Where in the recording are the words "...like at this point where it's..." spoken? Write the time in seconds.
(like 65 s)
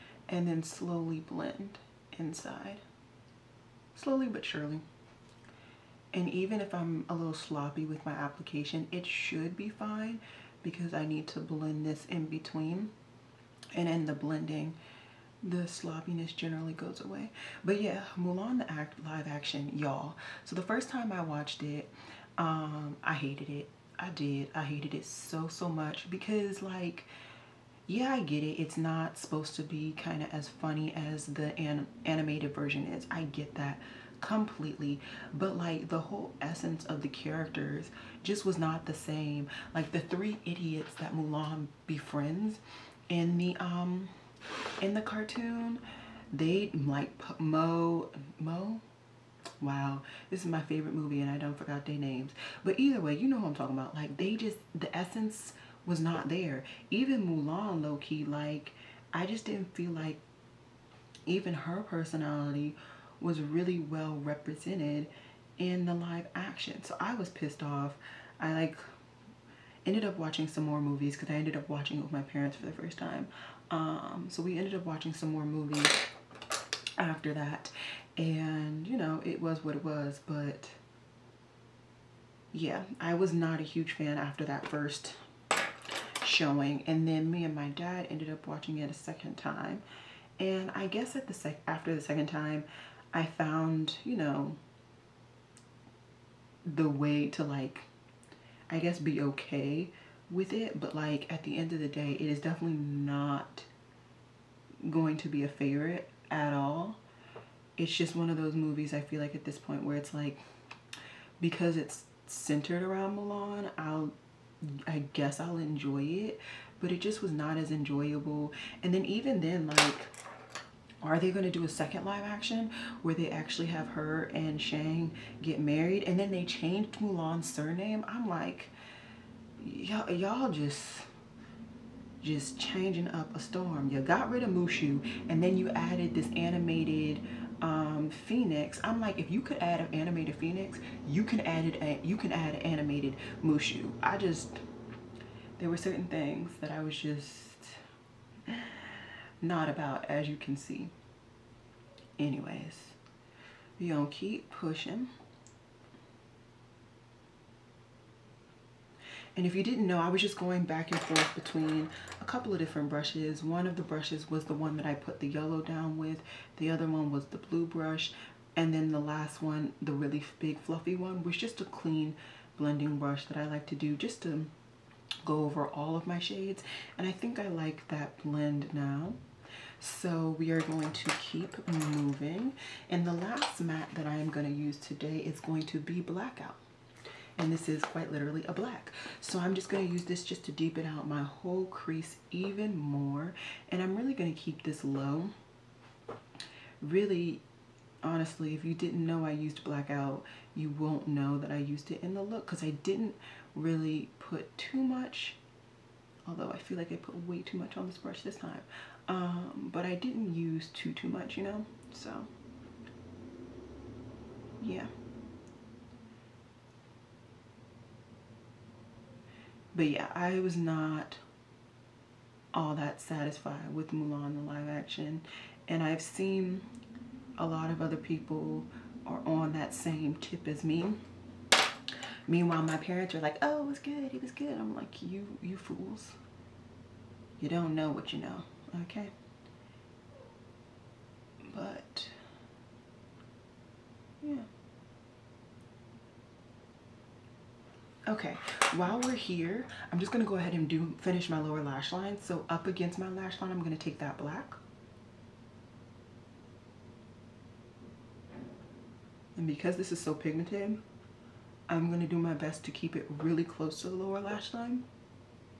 109 s.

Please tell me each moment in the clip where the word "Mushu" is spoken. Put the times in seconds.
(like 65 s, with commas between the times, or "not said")
134 s, 143 s.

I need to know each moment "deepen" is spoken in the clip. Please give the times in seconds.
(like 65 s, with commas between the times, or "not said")
190 s.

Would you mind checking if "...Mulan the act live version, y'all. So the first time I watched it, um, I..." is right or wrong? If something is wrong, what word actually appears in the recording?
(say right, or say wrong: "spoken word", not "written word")
wrong: "action", not "version".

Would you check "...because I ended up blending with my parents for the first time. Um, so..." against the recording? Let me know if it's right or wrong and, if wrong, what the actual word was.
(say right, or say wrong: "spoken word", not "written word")
wrong: "watching", not "blending".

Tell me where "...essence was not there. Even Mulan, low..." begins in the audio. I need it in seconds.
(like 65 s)
54 s.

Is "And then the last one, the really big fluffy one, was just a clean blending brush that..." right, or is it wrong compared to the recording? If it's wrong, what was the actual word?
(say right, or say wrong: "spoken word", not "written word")
right.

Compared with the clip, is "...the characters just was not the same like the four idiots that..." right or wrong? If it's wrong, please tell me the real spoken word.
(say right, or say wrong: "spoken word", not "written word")
wrong: "three", not "four".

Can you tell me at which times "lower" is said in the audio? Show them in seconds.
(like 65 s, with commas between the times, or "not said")
251 s, 263 s.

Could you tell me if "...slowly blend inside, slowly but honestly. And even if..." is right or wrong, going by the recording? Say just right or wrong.
wrong.